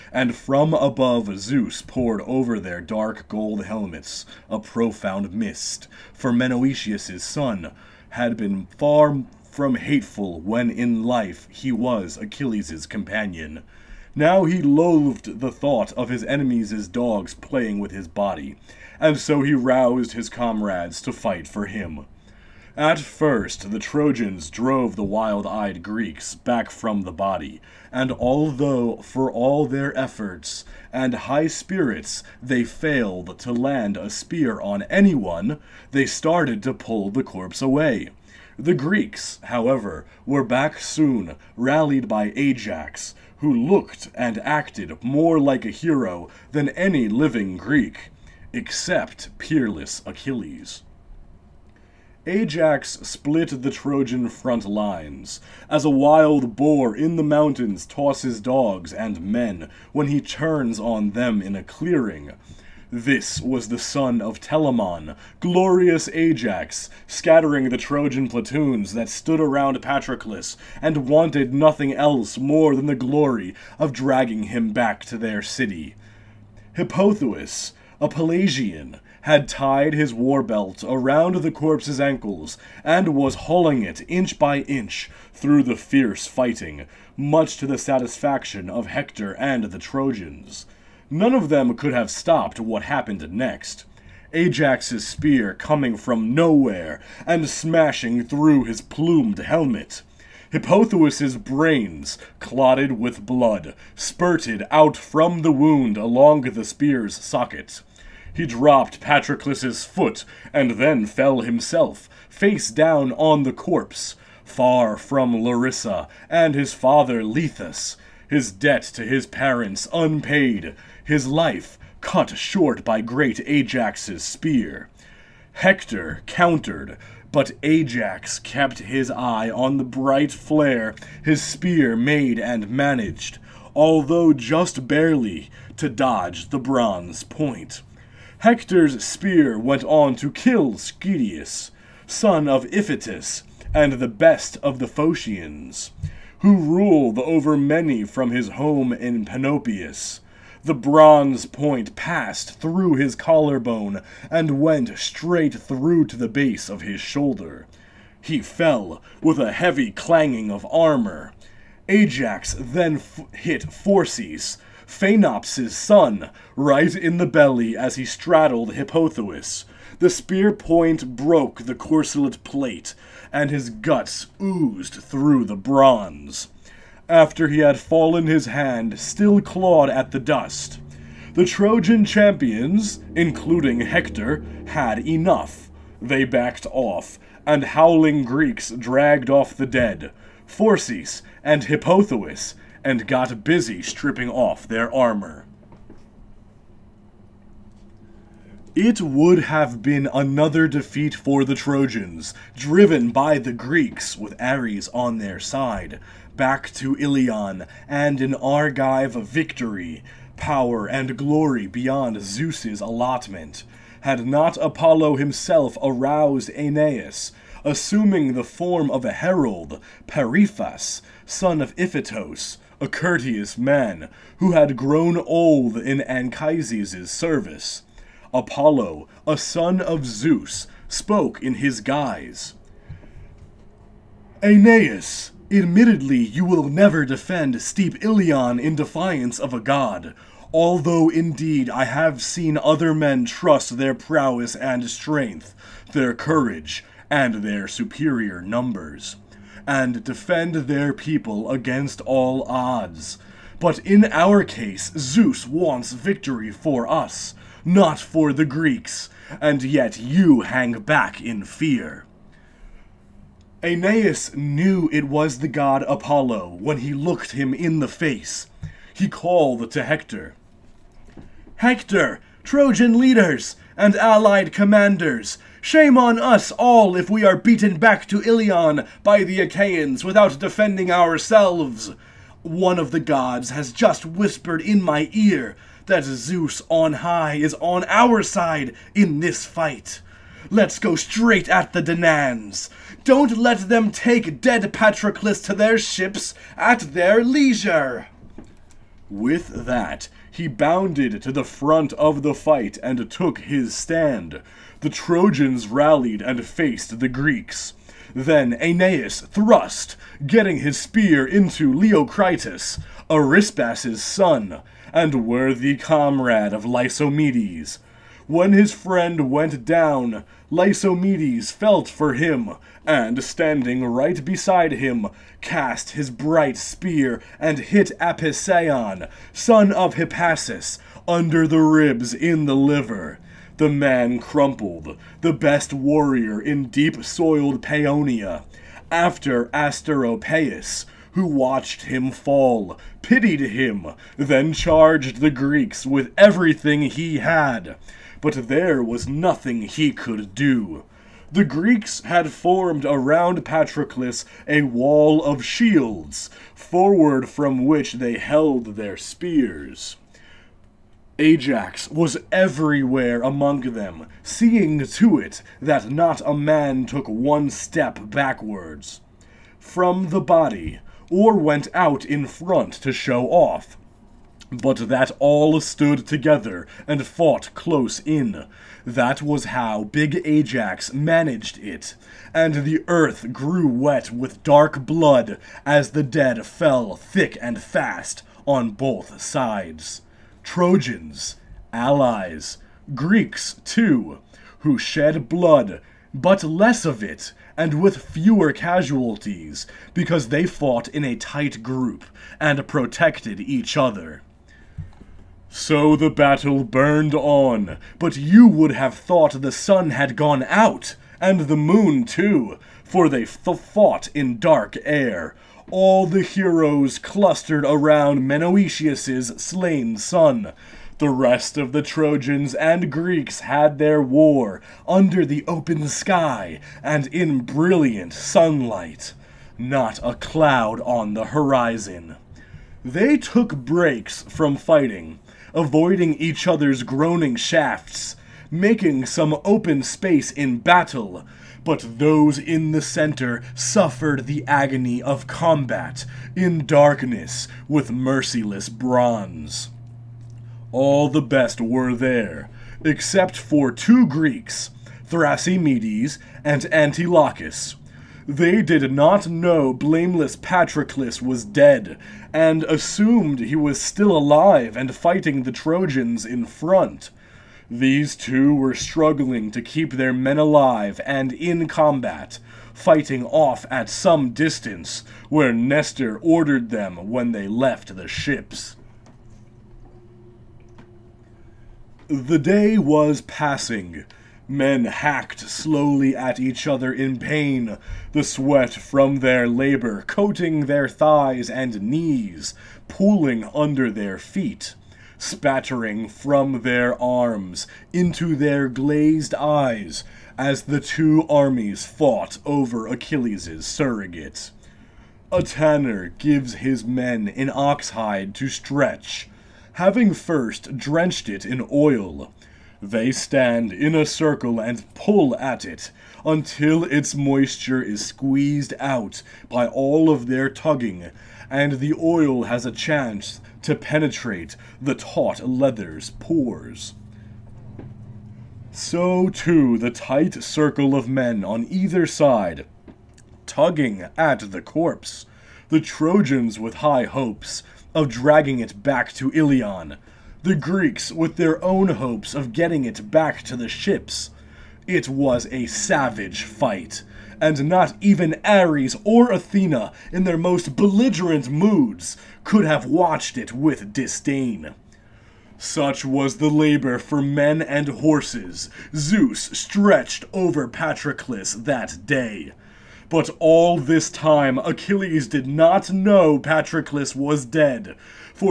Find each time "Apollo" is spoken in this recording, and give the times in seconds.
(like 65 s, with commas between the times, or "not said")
214 s, 228 s, 265 s.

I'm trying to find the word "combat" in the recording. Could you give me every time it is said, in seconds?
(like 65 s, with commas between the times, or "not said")
445 s, 471 s.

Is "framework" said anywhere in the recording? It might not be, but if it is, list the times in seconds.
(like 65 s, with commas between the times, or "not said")
not said.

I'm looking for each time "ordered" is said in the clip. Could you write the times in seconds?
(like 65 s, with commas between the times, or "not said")
476 s.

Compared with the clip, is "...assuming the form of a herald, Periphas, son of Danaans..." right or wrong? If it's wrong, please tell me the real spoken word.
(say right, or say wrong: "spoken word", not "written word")
wrong: "Iphitos", not "Danaans".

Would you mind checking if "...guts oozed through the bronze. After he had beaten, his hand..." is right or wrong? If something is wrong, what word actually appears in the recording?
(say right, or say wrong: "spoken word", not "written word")
wrong: "fallen", not "beaten".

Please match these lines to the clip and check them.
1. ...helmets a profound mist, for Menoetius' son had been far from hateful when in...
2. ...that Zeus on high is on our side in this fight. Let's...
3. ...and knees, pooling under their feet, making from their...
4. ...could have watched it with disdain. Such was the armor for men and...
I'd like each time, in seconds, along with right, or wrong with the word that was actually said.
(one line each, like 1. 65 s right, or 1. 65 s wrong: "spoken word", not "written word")
1. 3 s right
2. 285 s right
3. 491 s wrong: "spattering", not "making"
4. 552 s wrong: "labor", not "armor".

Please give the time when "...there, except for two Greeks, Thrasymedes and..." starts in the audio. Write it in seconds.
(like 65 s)
451 s.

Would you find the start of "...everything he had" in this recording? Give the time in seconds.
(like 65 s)
346 s.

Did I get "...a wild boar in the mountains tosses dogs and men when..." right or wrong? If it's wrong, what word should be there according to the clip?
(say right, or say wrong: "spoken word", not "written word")
right.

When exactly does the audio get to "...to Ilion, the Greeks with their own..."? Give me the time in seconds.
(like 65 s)
539 s.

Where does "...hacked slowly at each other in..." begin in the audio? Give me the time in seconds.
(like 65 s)
484 s.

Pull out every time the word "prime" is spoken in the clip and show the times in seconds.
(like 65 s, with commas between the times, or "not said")
not said.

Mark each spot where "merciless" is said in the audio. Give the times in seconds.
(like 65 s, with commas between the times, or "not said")
447 s.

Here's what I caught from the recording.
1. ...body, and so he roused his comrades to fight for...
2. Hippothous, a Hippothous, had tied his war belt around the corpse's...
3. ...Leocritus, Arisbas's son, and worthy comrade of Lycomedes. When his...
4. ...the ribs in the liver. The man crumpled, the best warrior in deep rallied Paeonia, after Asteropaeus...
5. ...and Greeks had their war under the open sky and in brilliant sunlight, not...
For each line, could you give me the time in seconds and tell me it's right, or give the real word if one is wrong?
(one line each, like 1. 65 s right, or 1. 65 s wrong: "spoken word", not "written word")
1. 18 s right
2. 76 s wrong: "Pelasgian", not "Hippothous"
3. 311 s right
4. 331 s wrong: "soiled", not "rallied"
5. 422 s right.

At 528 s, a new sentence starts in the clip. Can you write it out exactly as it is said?
So too the tight circle of men on either side, tugging at the corpse.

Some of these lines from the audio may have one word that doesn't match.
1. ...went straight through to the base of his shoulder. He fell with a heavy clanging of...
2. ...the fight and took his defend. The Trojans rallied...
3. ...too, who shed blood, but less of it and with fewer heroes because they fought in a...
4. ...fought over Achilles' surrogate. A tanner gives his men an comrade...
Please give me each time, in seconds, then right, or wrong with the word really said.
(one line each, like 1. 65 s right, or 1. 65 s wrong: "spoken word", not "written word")
1. 154 s right
2. 302 s wrong: "stand", not "defend"
3. 393 s wrong: "casualties", not "heroes"
4. 501 s wrong: "oxhide", not "comrade".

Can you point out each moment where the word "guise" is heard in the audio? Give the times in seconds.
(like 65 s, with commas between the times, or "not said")
231 s.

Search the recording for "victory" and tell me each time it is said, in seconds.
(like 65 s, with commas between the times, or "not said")
209 s, 255 s.